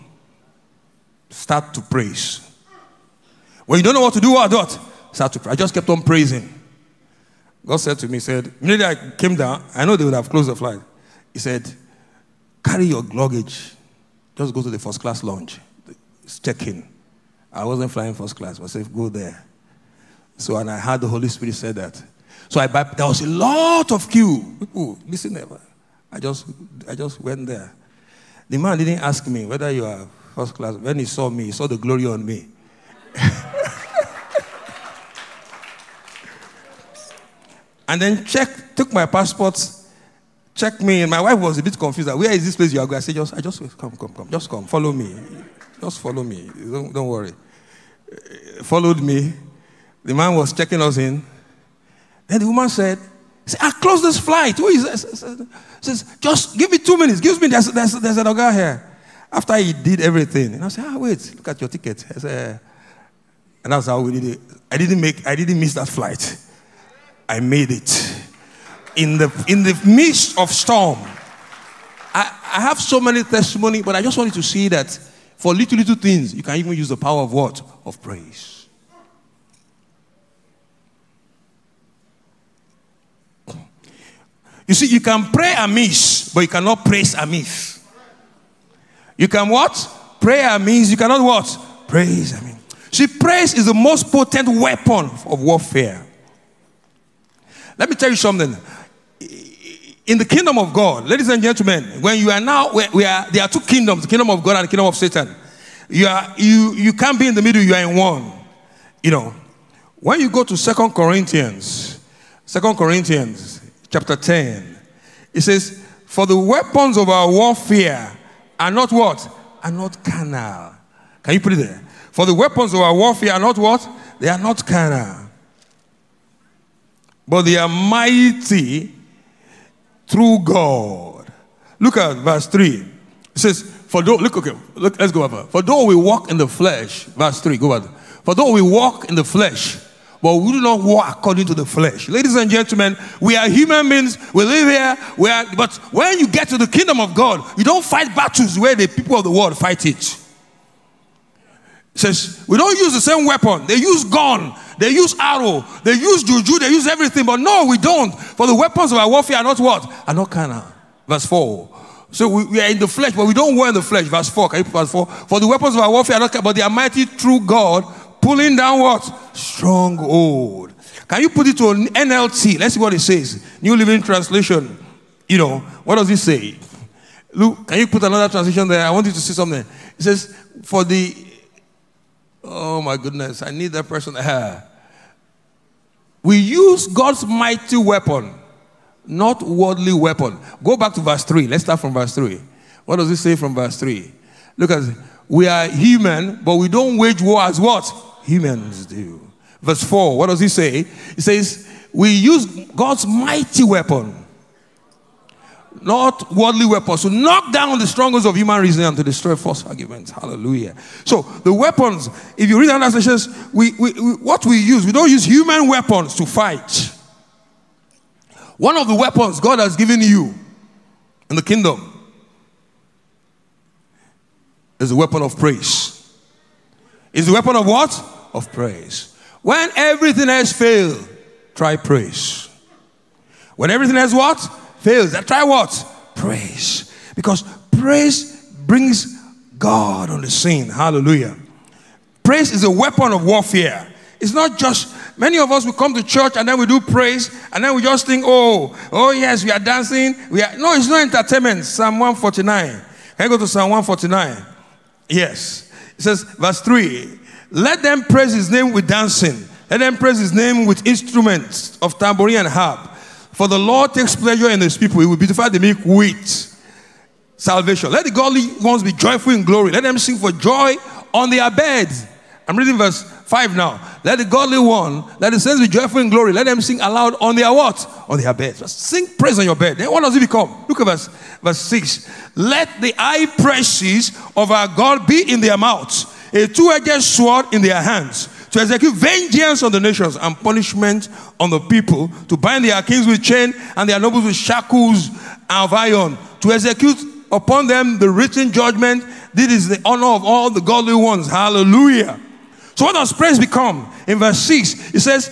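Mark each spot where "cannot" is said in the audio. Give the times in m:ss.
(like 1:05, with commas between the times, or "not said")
1:26, 1:30.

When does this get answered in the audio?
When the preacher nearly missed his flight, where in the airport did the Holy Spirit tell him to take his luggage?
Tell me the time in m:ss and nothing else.
0:14.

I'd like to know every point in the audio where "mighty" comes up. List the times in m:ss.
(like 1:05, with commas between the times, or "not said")
2:07, 2:46, 3:07, 3:23.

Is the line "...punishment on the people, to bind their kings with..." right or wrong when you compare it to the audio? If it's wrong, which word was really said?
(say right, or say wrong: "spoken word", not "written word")
right.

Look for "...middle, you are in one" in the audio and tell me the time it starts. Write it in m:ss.
1:47.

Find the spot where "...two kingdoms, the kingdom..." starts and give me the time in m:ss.
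1:43.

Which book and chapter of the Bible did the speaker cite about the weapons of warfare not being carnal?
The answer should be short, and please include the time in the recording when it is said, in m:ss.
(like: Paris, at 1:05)
Second Corinthians 10, at 1:52.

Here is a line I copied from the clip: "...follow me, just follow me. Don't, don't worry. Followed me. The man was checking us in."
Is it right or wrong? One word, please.
right.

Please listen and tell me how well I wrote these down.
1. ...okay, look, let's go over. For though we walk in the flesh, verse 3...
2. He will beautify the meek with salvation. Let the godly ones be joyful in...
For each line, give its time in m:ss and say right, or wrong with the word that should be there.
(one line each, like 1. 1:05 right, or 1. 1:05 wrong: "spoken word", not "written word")
1. 2:14 right
2. 4:24 right.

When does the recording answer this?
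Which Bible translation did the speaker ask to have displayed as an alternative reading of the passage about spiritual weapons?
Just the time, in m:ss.
2:53.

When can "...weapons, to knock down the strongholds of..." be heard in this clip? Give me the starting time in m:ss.
3:26.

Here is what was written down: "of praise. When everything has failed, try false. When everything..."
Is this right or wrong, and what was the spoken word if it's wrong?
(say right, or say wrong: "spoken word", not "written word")
wrong: "praise", not "false".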